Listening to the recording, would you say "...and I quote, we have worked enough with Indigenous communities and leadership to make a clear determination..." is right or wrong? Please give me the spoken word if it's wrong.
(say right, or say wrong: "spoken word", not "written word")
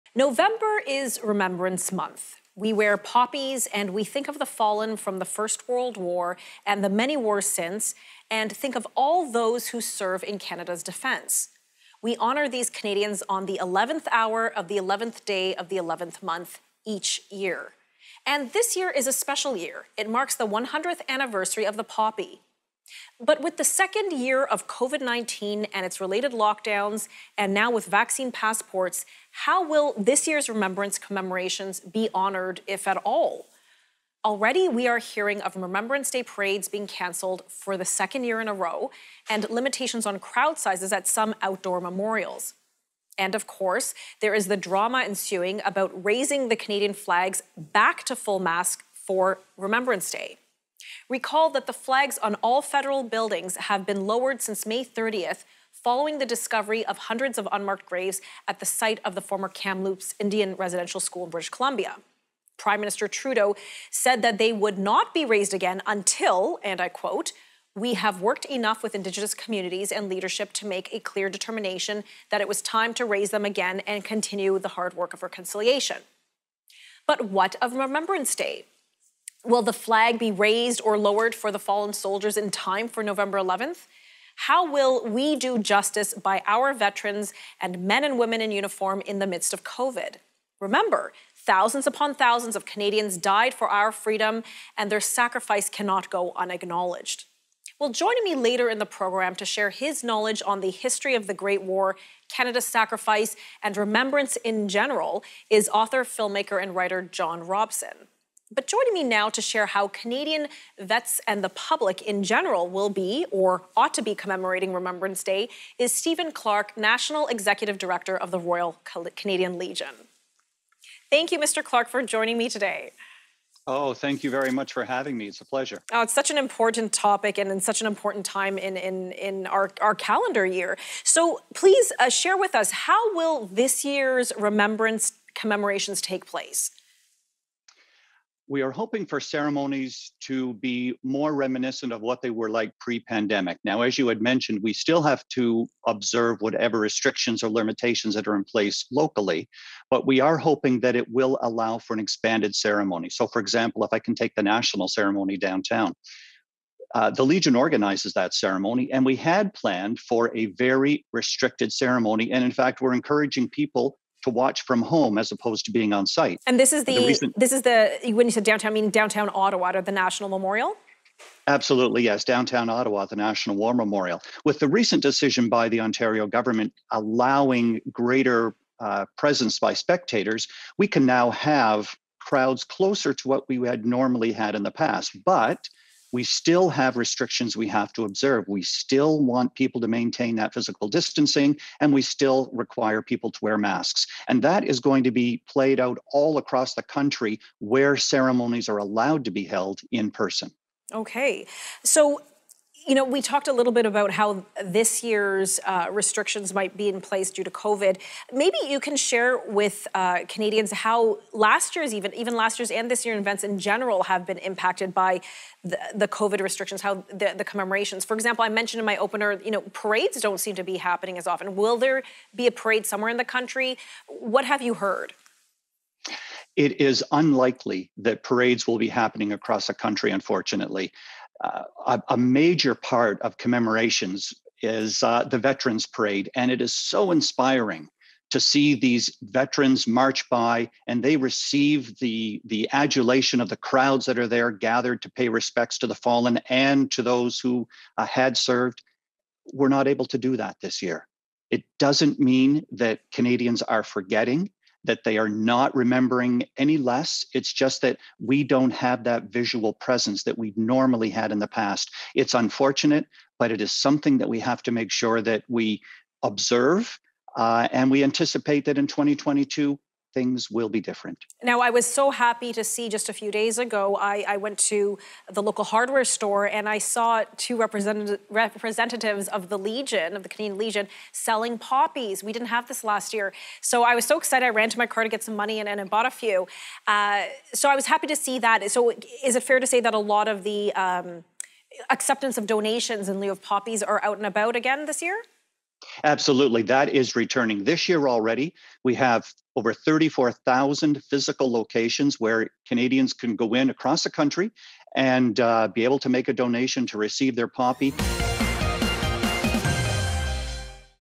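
right.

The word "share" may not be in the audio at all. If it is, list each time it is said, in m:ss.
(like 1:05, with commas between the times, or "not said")
1:39, 1:49, 2:12, 3:28.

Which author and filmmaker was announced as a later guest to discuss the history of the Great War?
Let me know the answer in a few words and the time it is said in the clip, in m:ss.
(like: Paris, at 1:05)
John Robson, at 1:47.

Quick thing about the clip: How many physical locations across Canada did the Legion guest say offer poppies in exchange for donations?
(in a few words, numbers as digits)
34,000.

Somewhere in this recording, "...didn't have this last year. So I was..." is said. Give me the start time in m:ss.
4:42.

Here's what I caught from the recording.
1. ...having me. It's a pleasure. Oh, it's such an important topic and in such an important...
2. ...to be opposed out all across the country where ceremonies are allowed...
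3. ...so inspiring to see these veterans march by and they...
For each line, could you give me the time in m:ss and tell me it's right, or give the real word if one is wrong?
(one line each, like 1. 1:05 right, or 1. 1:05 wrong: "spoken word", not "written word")
1. 2:04 right
2. 3:15 wrong: "played", not "opposed"
3. 3:56 right.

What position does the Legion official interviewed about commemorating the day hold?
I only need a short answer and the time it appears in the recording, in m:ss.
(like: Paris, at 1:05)
National Executive Director, at 1:56.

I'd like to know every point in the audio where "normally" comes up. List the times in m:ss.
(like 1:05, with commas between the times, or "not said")
3:03, 4:20.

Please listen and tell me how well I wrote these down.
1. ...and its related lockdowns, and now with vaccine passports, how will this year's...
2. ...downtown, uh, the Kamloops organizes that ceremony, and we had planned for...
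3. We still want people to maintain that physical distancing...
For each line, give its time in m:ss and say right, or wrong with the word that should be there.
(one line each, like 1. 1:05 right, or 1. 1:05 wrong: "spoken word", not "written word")
1. 0:25 right
2. 2:35 wrong: "Legion", not "Kamloops"
3. 3:08 right.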